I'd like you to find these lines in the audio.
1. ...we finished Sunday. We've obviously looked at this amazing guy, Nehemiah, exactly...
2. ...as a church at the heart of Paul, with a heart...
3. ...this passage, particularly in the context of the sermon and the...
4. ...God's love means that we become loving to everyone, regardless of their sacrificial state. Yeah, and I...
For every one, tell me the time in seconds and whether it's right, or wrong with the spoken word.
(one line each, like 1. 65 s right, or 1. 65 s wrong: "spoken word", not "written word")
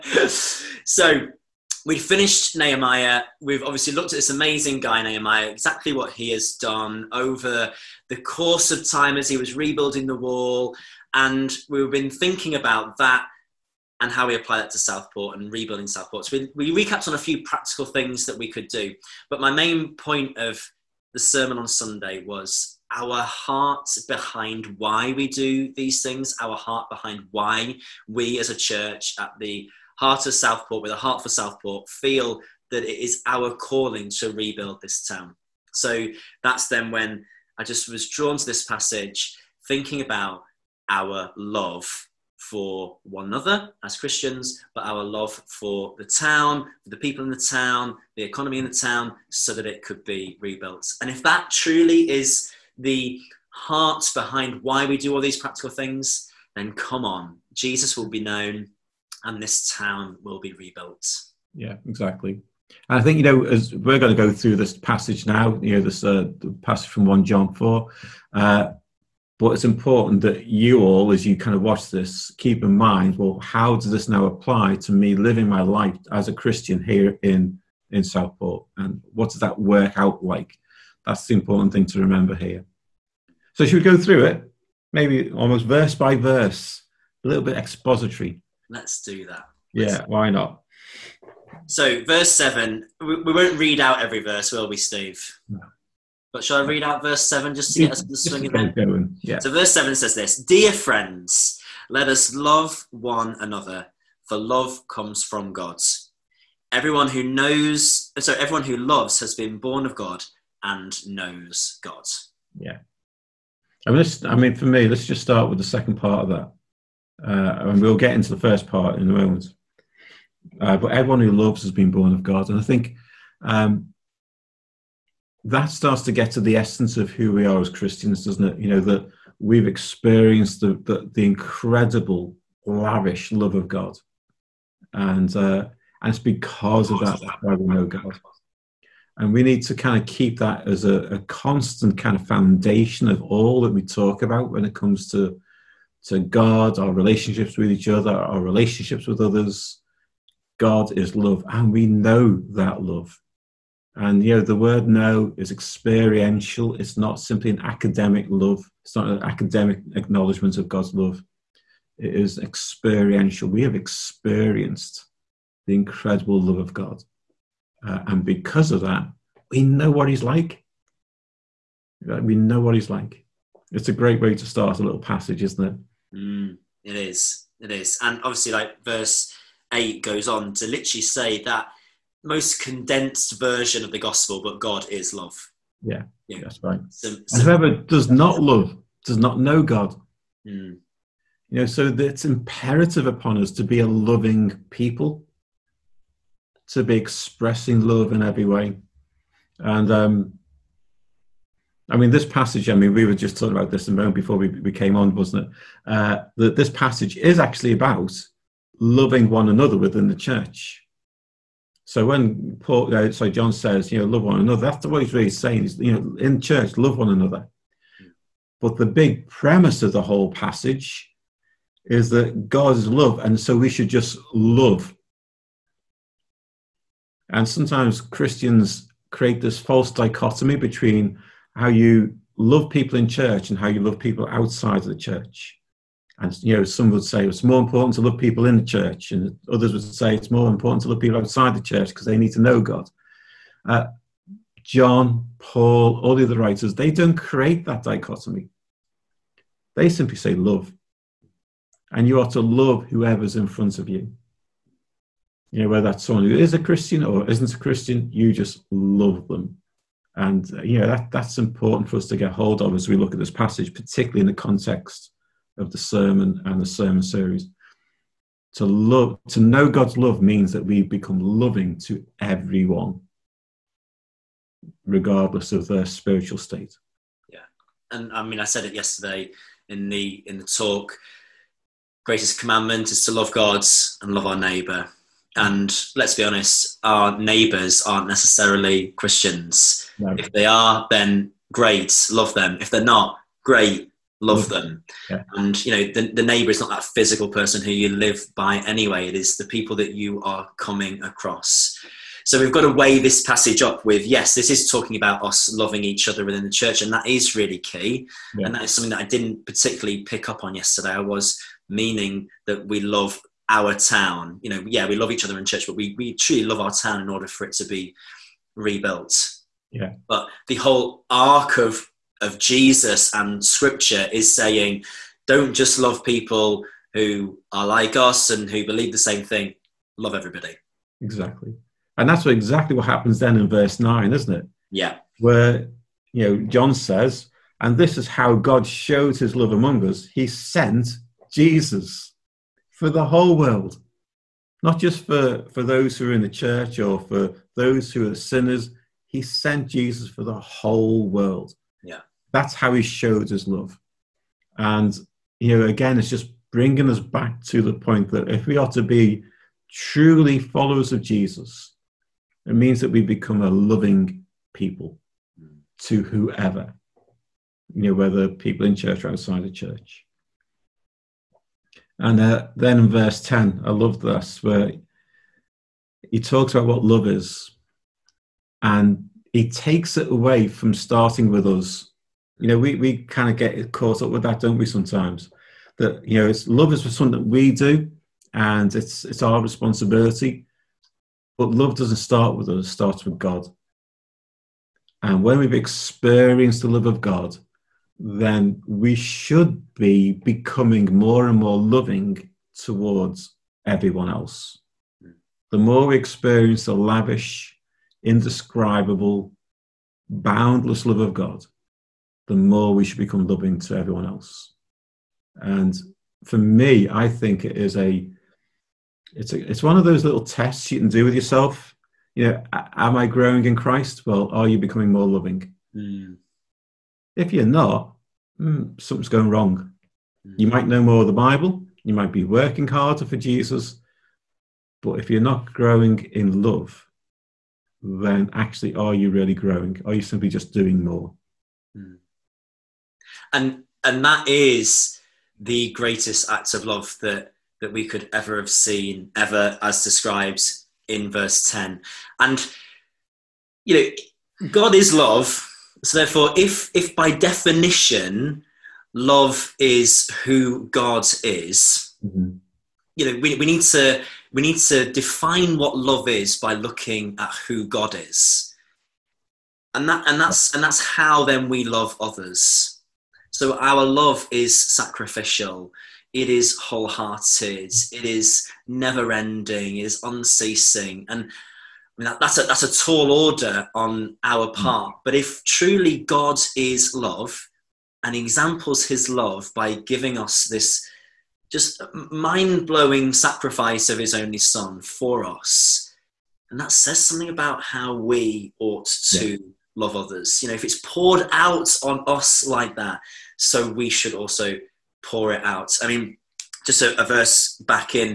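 1. 1 s wrong: "Nehemiah", not "Sunday"
2. 28 s wrong: "Southport", not "Paul"
3. 263 s right
4. 269 s wrong: "spiritual", not "sacrificial".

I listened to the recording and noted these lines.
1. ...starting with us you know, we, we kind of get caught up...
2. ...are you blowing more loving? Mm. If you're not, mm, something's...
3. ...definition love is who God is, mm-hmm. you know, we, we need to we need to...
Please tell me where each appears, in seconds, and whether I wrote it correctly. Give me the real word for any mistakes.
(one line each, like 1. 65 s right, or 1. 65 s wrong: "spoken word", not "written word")
1. 380 s right
2. 424 s wrong: "becoming", not "blowing"
3. 457 s right.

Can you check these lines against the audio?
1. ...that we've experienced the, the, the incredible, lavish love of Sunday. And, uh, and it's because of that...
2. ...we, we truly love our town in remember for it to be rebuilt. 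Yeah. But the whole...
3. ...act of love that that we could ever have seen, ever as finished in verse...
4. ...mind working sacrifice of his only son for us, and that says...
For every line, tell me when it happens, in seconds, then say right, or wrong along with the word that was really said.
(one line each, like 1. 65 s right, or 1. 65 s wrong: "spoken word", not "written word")
1. 128 s wrong: "God", not "Sunday"
2. 315 s wrong: "order", not "remember"
3. 446 s wrong: "described", not "finished"
4. 491 s wrong: "blowing", not "working".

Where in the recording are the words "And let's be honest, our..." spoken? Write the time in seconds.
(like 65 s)
285 s.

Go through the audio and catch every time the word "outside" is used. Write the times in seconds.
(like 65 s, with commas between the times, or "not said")
234 s, 241 s, 369 s.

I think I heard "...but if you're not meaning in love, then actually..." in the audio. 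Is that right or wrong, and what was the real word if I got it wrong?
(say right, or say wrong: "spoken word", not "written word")
wrong: "growing", not "meaning".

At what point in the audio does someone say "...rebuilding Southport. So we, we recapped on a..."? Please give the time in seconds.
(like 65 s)
15 s.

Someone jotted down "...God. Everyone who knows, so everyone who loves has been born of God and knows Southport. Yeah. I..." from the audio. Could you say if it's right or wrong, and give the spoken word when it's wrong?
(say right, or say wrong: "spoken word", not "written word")
wrong: "God", not "Southport".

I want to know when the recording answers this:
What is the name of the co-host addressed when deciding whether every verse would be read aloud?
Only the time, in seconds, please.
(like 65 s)
94 s.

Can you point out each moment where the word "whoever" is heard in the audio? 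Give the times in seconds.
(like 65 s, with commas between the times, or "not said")
187 s, 252 s, 366 s.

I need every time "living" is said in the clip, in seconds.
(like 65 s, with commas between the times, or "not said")
75 s.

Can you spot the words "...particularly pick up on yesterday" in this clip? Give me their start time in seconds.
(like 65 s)
309 s.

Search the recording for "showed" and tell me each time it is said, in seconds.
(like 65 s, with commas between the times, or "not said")
338 s, 352 s.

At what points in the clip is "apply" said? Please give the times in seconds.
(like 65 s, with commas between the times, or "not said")
14 s, 74 s.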